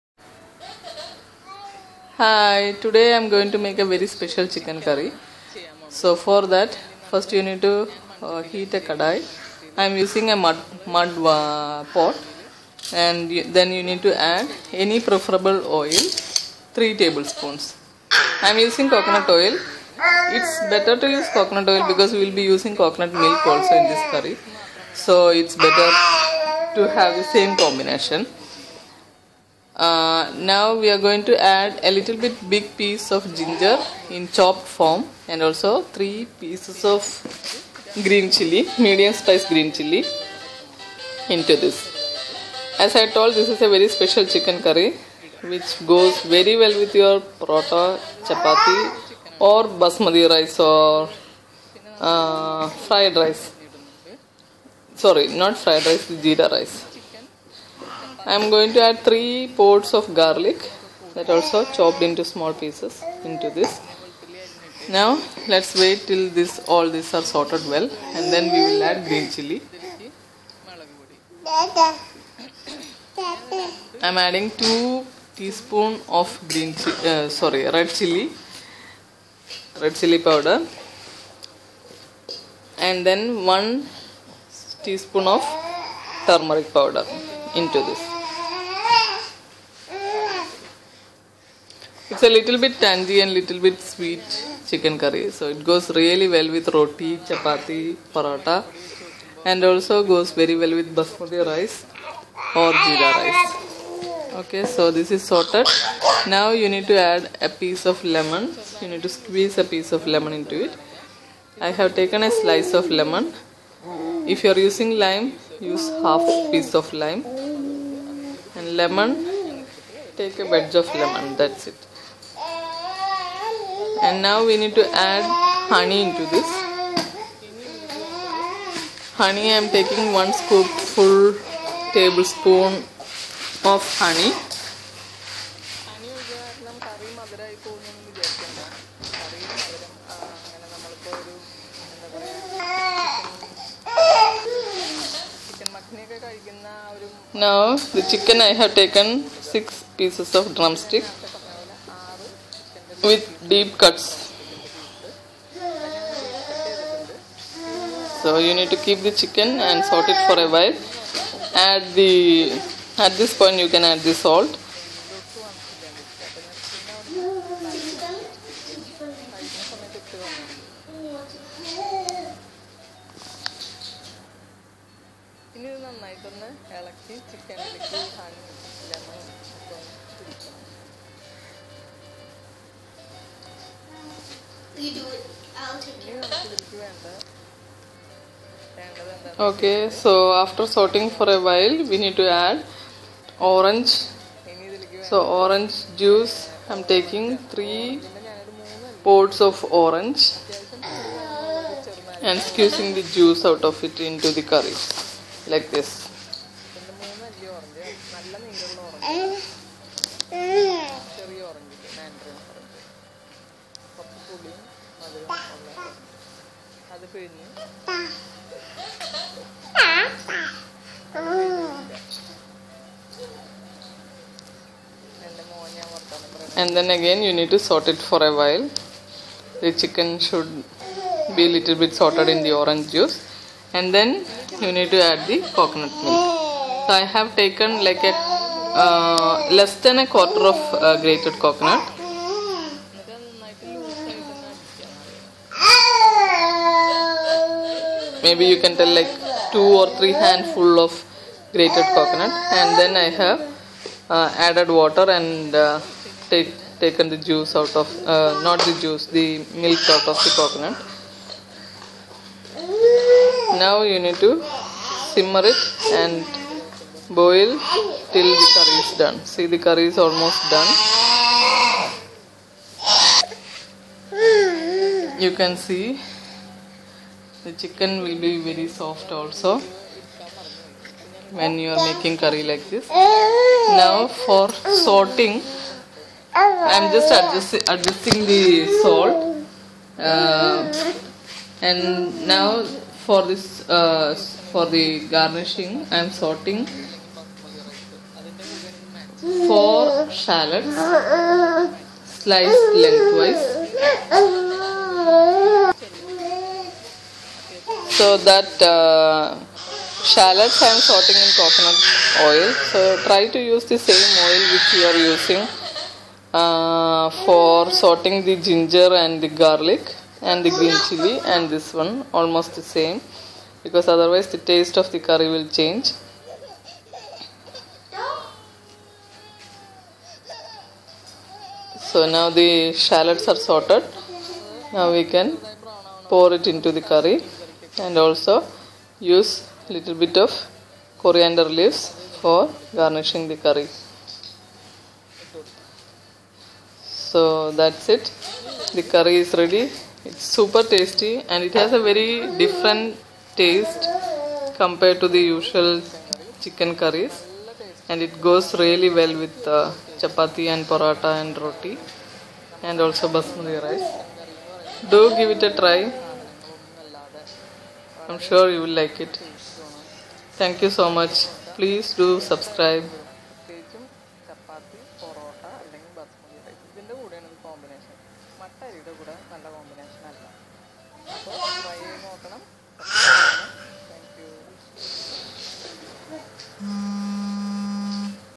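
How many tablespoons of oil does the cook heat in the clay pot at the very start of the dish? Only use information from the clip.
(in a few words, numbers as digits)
3.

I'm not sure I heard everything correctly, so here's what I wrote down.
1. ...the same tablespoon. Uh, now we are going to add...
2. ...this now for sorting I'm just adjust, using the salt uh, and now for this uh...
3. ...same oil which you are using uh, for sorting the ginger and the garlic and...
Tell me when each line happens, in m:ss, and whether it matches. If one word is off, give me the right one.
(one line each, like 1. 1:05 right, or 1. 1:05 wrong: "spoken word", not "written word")
1. 0:27 wrong: "combination", not "tablespoon"
2. 4:42 wrong: "adjusting", not "using"
3. 5:13 right.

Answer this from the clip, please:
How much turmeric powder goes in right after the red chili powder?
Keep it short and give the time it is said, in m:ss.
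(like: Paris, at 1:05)
1 teaspoon, at 1:23.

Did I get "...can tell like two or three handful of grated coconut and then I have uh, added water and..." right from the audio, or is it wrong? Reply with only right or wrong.
right.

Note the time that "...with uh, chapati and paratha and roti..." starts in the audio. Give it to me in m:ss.
5:59.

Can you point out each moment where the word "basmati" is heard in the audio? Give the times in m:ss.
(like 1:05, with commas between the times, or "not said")
0:49, 1:40, 6:03.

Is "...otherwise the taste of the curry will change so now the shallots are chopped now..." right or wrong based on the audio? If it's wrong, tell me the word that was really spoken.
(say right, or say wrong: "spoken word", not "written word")
wrong: "sorted", not "chopped".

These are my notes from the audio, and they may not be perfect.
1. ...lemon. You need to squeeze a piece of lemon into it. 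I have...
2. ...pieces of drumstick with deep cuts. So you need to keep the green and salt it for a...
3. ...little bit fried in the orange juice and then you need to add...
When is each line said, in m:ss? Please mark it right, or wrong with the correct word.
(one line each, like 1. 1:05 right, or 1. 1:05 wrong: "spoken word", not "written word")
1. 1:48 right
2. 2:29 wrong: "chicken", not "green"
3. 3:51 wrong: "sorted", not "fried".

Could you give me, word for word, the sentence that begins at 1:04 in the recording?
Now let's wait till this all these are sorted well and then we will add green chili.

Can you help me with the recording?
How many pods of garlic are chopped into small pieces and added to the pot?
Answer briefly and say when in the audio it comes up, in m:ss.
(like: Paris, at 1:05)
3, at 0:58.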